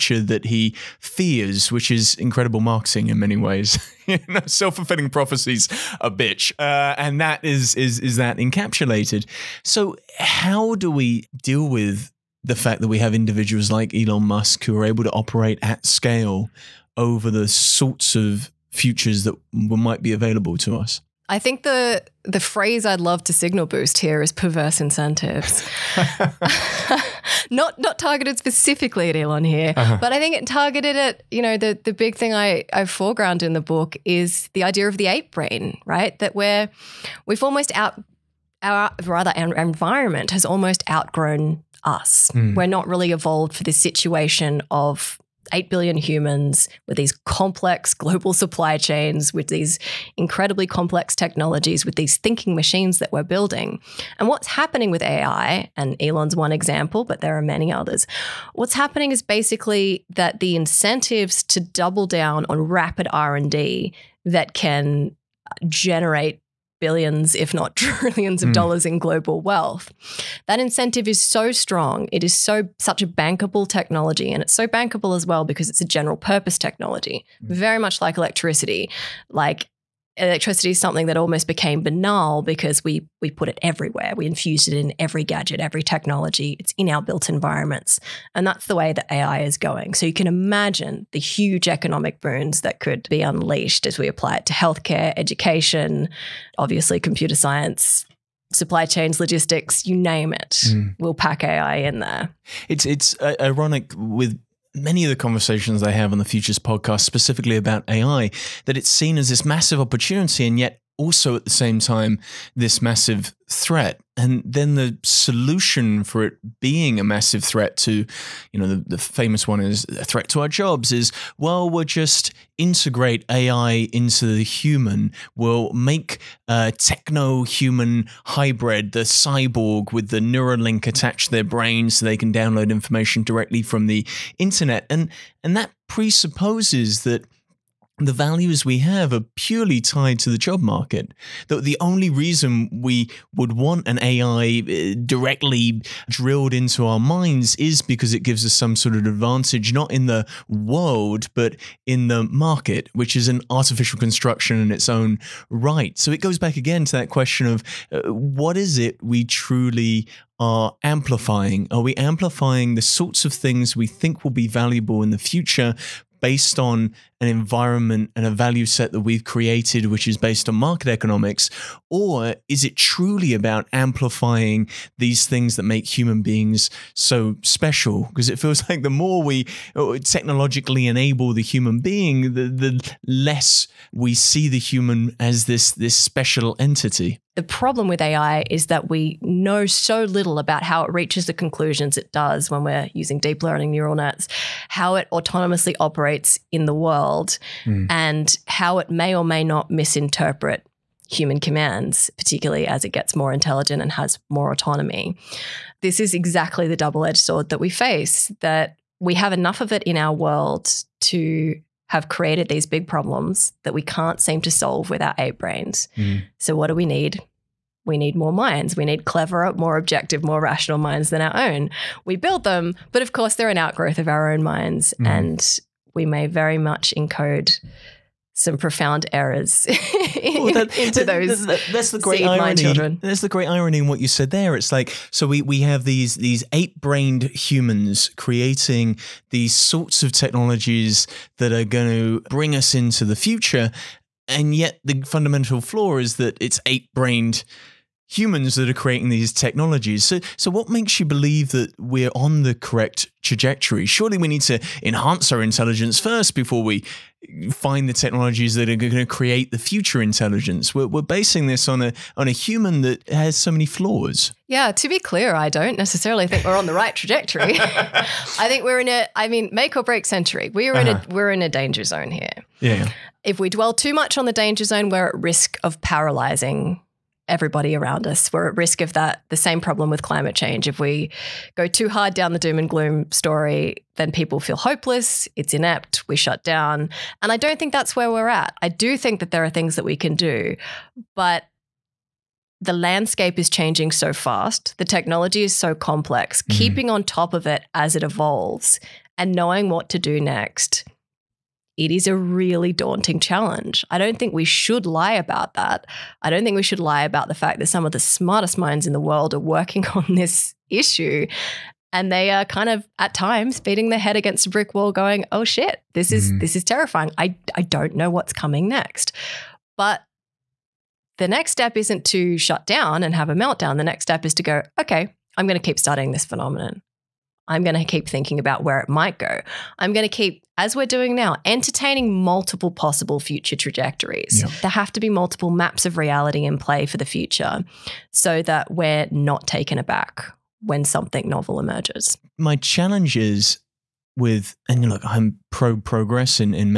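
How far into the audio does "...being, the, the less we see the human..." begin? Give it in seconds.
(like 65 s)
181 s.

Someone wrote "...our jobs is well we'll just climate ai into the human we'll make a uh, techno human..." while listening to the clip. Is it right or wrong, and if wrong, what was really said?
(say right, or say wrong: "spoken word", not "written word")
wrong: "integrate", not "climate".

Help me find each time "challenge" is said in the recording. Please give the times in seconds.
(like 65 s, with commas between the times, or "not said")
303 s, 342 s.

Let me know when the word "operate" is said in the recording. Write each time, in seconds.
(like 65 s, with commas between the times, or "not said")
15 s, 195 s.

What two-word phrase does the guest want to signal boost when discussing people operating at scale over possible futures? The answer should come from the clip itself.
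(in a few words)
perverse incentives.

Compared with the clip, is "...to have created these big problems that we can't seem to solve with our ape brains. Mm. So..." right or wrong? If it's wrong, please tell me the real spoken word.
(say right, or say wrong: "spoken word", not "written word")
right.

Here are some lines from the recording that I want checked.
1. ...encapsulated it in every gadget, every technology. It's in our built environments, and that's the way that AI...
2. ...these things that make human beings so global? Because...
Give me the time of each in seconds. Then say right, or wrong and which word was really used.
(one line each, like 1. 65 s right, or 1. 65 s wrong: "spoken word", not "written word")
1. 84 s wrong: "infused", not "encapsulated"
2. 174 s wrong: "special", not "global".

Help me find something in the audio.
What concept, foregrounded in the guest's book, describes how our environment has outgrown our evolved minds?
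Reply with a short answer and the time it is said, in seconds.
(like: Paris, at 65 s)
the ape brain, at 35 s.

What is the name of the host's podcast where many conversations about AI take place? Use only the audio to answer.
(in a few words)
Futures podcast.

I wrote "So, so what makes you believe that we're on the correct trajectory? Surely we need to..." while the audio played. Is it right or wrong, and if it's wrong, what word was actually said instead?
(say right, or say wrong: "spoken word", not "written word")
right.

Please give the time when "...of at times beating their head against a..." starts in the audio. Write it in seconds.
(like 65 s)
312 s.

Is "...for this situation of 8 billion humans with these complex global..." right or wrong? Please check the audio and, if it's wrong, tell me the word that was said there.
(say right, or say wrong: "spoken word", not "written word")
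right.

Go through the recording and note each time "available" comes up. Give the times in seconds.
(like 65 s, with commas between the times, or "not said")
20 s.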